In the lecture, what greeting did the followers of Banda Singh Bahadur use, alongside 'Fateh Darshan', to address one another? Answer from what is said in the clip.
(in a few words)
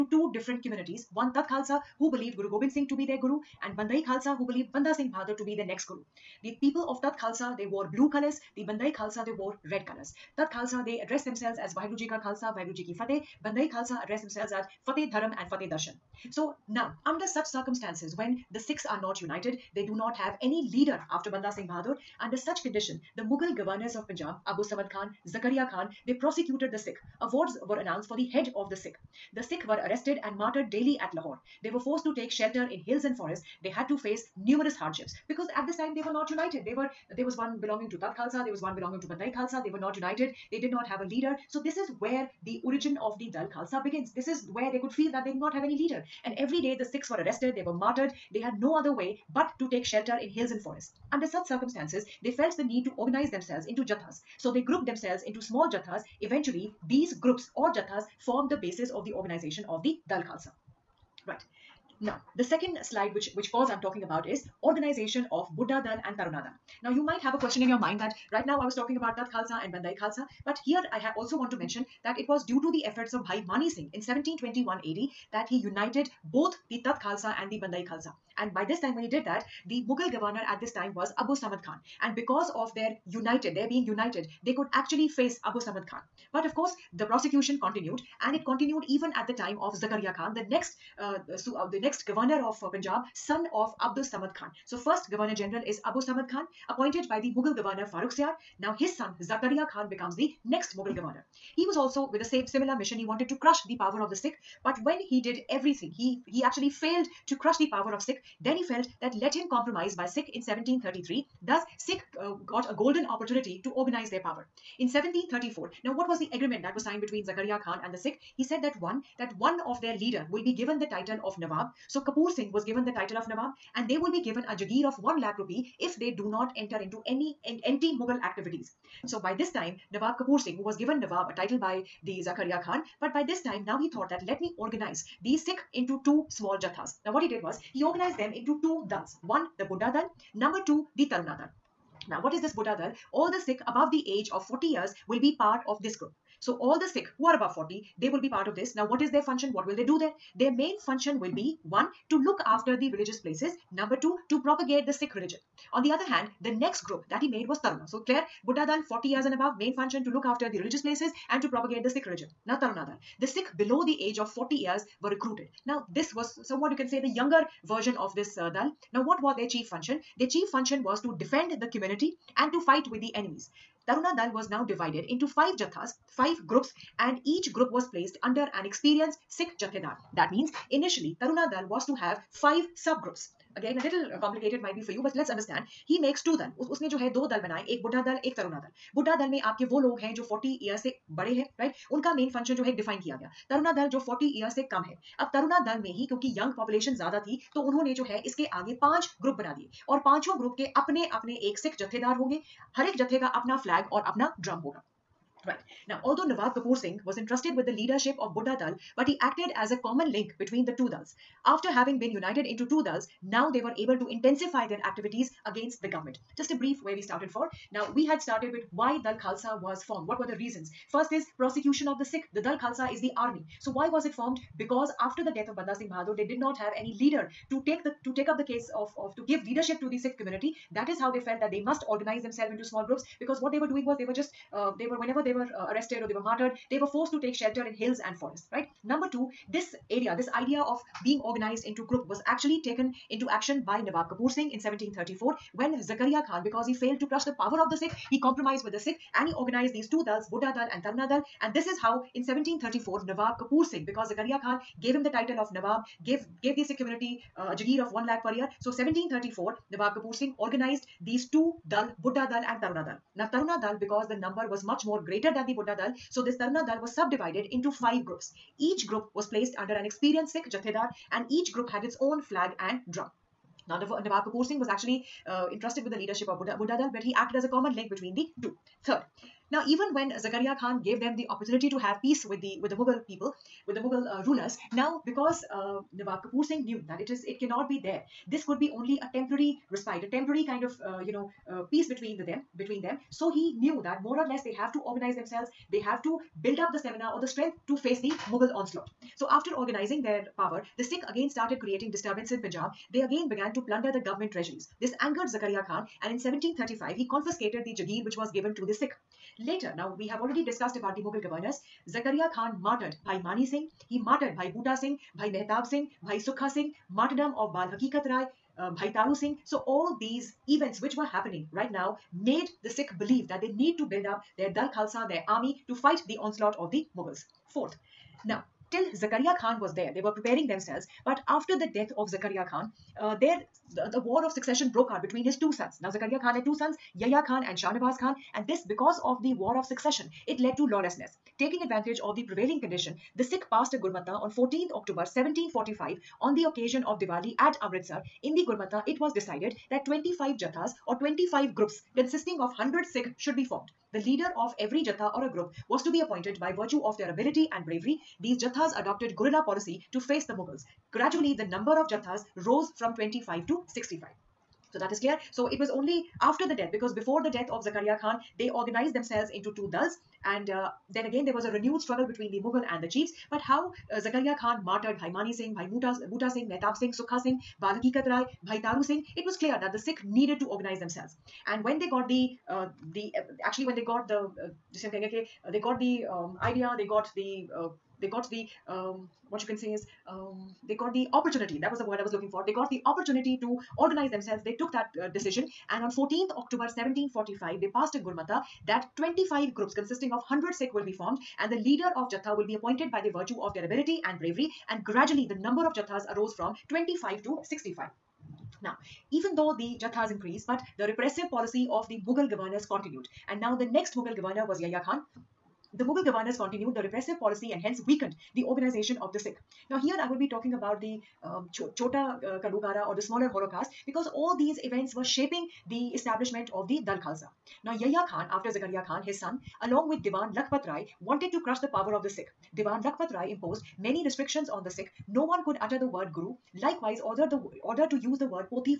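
Fateh Dharam.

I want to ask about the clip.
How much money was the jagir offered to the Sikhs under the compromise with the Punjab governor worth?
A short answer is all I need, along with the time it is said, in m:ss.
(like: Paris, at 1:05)
1 lakh rupees, at 2:05.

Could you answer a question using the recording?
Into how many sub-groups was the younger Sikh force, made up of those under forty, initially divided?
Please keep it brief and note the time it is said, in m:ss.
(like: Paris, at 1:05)
5, at 2:55.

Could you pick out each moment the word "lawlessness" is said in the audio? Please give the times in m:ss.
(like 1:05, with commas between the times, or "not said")
5:40.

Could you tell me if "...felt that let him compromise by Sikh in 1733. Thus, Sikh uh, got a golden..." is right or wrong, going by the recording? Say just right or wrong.
right.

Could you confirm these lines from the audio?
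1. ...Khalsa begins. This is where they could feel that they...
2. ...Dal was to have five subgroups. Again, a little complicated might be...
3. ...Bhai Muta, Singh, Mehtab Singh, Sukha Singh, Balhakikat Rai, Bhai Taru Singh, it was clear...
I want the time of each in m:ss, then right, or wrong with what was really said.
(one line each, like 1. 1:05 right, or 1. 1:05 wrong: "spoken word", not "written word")
1. 0:43 right
2. 3:01 right
3. 6:15 right.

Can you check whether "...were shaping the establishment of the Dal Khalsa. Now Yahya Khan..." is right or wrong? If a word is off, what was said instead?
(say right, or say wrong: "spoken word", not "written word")
right.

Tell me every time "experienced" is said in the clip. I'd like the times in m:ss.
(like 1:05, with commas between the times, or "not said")
2:58, 4:29.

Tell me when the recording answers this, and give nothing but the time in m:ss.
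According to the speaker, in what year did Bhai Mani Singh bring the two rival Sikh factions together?
1:14.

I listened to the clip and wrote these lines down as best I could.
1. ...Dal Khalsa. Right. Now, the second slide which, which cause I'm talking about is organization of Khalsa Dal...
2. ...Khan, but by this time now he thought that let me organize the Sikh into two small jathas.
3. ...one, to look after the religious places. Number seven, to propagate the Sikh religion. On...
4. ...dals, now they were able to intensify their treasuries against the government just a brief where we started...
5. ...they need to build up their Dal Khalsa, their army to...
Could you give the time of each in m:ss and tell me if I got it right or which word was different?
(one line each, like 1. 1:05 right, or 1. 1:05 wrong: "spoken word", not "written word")
1. 1:00 wrong: "Buddha", not "Khalsa"
2. 2:12 right
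3. 2:31 wrong: "two", not "seven"
4. 3:32 wrong: "activities", not "treasuries"
5. 5:23 right.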